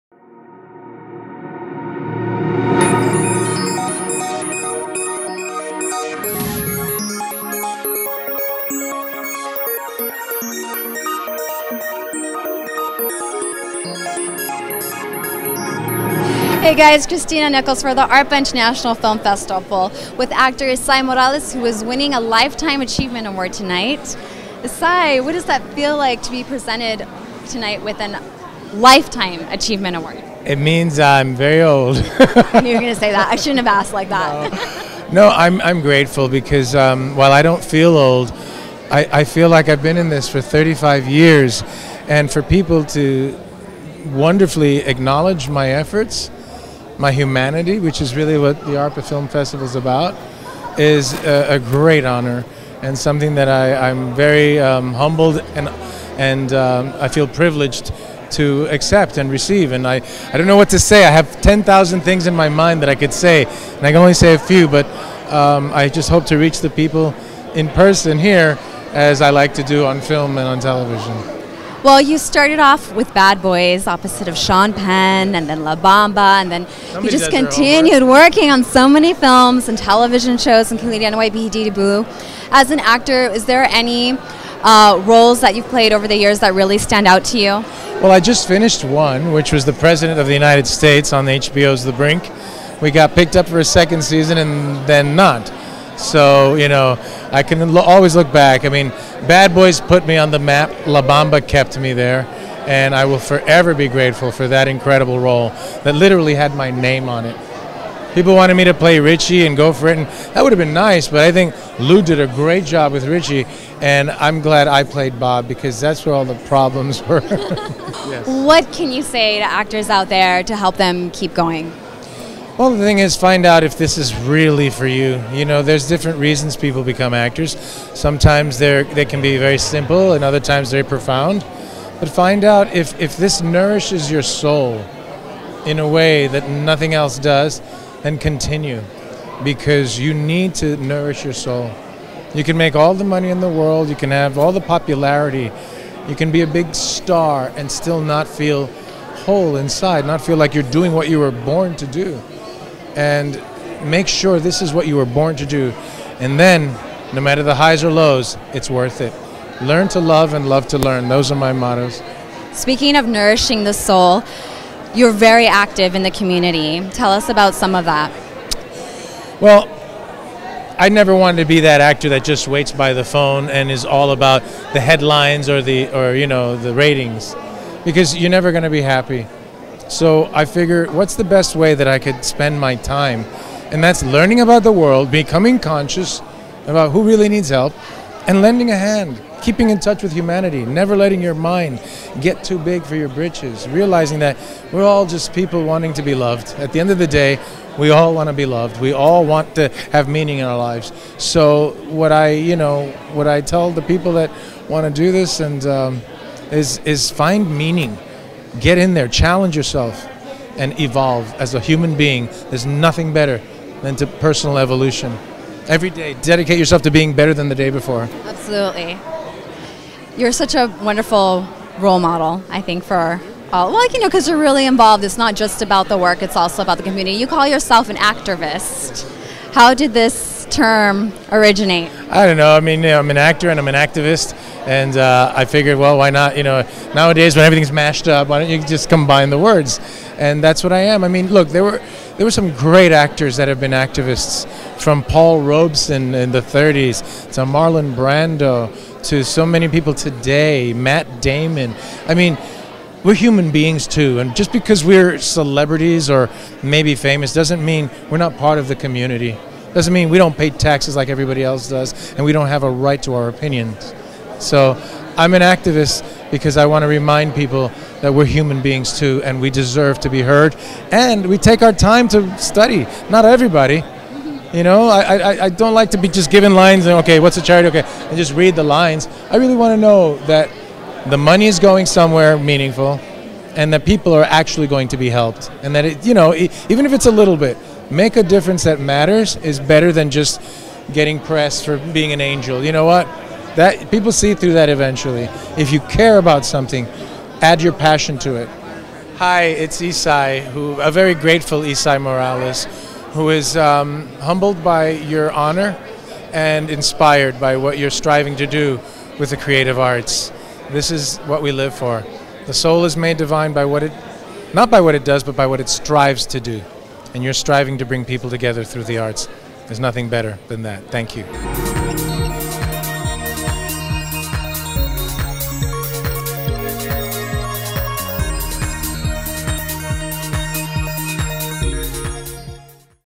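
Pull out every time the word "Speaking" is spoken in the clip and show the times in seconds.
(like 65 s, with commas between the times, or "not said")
162 s.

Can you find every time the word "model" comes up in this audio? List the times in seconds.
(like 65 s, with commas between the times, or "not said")
221 s.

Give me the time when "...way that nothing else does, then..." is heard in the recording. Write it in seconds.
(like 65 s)
135 s.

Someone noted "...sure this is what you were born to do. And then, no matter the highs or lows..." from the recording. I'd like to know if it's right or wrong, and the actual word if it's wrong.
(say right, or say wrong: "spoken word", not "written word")
right.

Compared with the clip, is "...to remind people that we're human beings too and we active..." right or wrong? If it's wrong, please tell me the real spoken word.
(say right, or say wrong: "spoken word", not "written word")
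wrong: "deserve", not "active".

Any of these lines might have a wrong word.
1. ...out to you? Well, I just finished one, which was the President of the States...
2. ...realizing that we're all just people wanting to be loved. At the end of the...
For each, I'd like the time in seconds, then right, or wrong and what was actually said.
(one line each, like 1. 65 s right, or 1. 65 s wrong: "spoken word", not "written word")
1. 87 s wrong: "United", not "States"
2. 193 s right.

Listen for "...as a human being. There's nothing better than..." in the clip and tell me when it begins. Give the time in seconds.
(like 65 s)
211 s.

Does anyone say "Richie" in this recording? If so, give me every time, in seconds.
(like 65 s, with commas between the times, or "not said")
108 s, 113 s.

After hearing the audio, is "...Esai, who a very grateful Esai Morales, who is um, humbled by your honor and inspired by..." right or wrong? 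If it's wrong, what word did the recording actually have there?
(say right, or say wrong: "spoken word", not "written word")
right.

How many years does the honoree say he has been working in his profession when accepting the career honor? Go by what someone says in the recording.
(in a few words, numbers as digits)
35.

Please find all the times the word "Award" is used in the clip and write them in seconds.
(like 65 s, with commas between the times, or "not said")
23 s, 29 s.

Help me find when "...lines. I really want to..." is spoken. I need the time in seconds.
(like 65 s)
278 s.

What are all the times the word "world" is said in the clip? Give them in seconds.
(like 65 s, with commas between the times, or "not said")
143 s, 184 s.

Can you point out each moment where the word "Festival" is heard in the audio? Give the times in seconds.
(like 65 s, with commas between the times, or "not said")
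19 s, 49 s.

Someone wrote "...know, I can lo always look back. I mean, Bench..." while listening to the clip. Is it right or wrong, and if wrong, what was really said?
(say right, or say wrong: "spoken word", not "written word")
wrong: "Bad", not "Bench".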